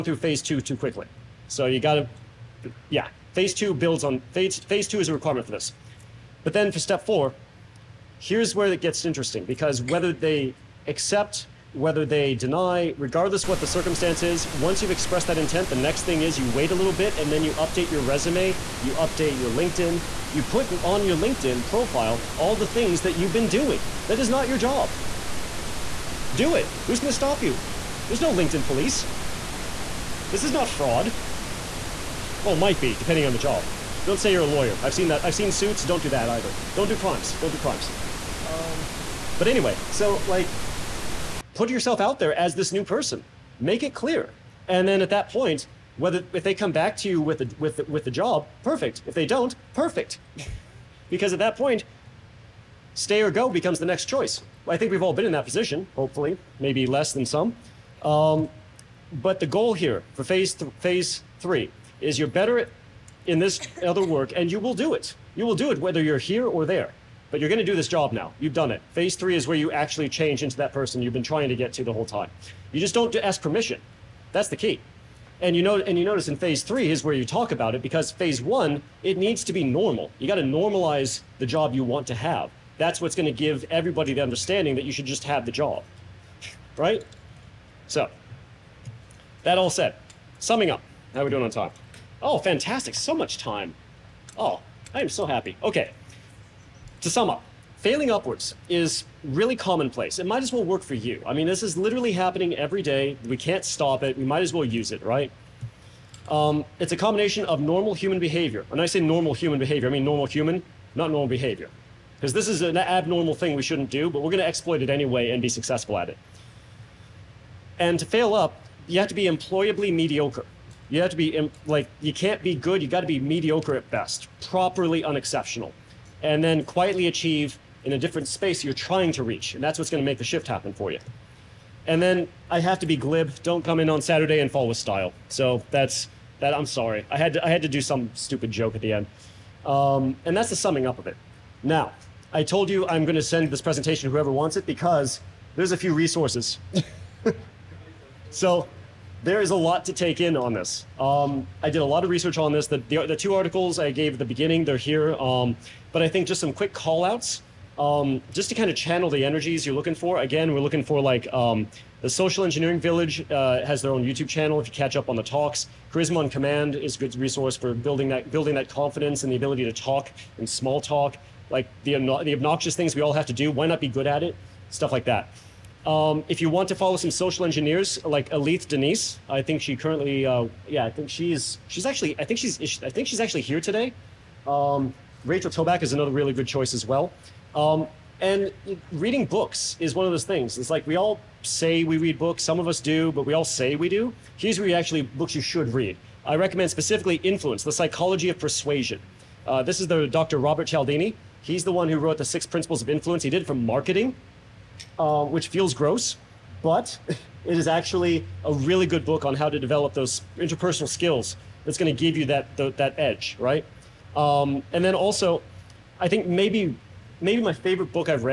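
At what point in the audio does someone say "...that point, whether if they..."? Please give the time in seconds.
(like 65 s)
45 s.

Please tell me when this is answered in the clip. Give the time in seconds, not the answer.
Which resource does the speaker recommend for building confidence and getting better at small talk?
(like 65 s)
165 s.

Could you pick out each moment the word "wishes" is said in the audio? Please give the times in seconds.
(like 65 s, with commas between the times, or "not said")
not said.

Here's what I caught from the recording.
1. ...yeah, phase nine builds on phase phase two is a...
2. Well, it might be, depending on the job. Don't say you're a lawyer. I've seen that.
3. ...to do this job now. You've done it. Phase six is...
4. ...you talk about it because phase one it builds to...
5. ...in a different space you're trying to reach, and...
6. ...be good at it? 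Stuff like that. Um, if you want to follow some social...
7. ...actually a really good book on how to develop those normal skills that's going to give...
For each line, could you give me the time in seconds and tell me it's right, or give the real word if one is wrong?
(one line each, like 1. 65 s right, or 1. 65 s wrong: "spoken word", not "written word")
1. 2 s wrong: "two", not "nine"
2. 32 s right
3. 67 s wrong: "three", not "six"
4. 77 s wrong: "needs", not "builds"
5. 127 s right
6. 173 s right
7. 207 s wrong: "interpersonal", not "normal".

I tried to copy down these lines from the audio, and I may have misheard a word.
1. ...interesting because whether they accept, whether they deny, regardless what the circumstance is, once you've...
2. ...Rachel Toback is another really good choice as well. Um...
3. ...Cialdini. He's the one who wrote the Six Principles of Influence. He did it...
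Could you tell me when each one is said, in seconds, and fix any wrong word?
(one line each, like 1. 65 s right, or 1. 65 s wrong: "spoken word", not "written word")
1. 9 s right
2. 185 s right
3. 200 s right.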